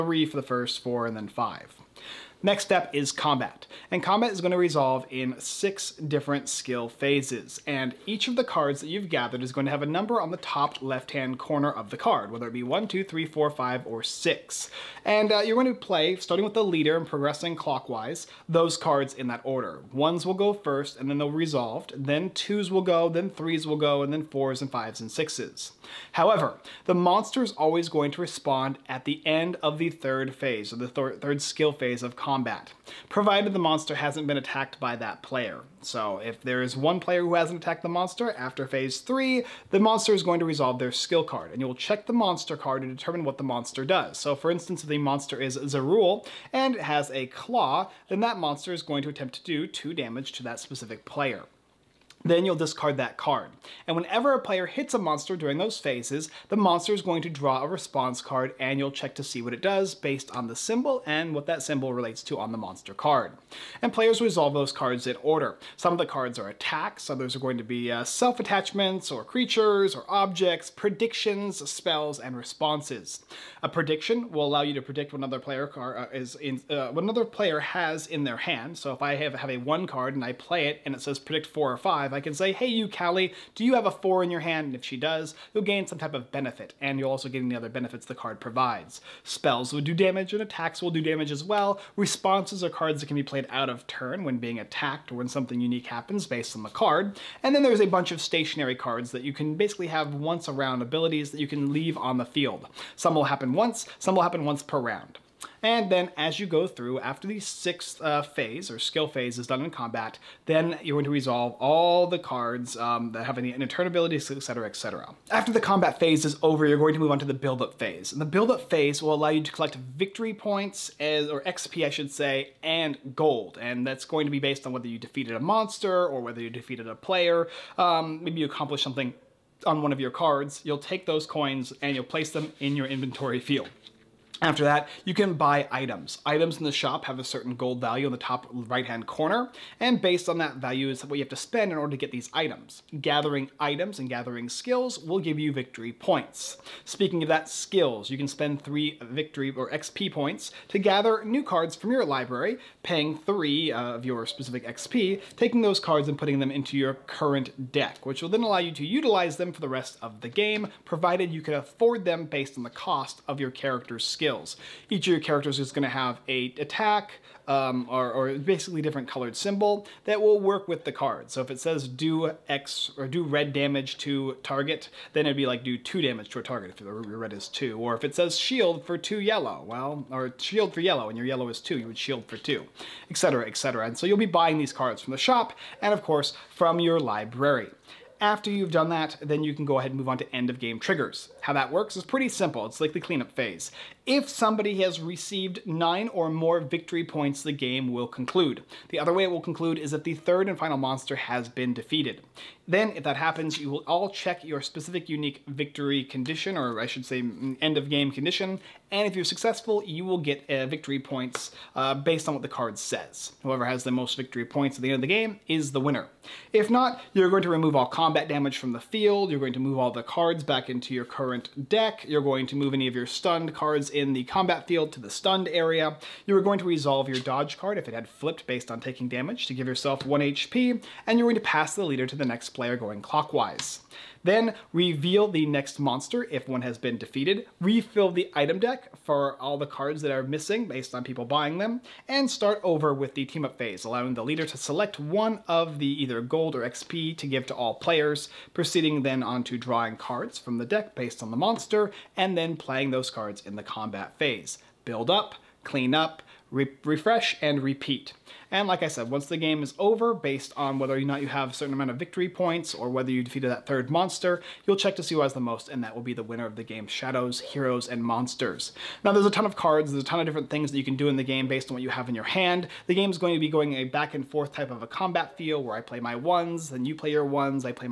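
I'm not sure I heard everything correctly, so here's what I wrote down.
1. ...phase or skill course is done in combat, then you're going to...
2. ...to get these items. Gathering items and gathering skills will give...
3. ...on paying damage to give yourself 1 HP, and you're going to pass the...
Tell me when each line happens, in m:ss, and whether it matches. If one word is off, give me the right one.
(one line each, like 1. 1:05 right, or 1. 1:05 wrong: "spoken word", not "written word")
1. 1:48 wrong: "phase", not "course"
2. 2:21 right
3. 3:48 wrong: "taking", not "paying".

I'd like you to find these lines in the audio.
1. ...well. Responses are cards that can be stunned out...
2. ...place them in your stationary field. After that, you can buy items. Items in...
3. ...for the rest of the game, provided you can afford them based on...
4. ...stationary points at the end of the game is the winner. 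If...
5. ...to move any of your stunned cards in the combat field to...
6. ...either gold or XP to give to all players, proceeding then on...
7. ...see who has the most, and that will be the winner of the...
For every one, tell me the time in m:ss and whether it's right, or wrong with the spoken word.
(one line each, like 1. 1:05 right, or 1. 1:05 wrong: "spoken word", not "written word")
1. 1:31 wrong: "played", not "stunned"
2. 2:12 wrong: "inventory", not "stationary"
3. 2:39 right
4. 3:34 wrong: "victory", not "stationary"
5. 3:42 right
6. 4:06 right
7. 4:25 right.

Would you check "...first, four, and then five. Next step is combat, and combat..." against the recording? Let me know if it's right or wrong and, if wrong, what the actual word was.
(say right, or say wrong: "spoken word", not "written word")
right.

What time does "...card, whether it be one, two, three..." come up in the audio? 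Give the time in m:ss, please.
0:11.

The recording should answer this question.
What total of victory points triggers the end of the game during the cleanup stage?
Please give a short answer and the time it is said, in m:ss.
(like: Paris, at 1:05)
9, at 3:15.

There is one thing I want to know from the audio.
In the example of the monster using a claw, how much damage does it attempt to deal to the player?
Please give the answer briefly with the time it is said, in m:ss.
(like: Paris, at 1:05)
2, at 0:49.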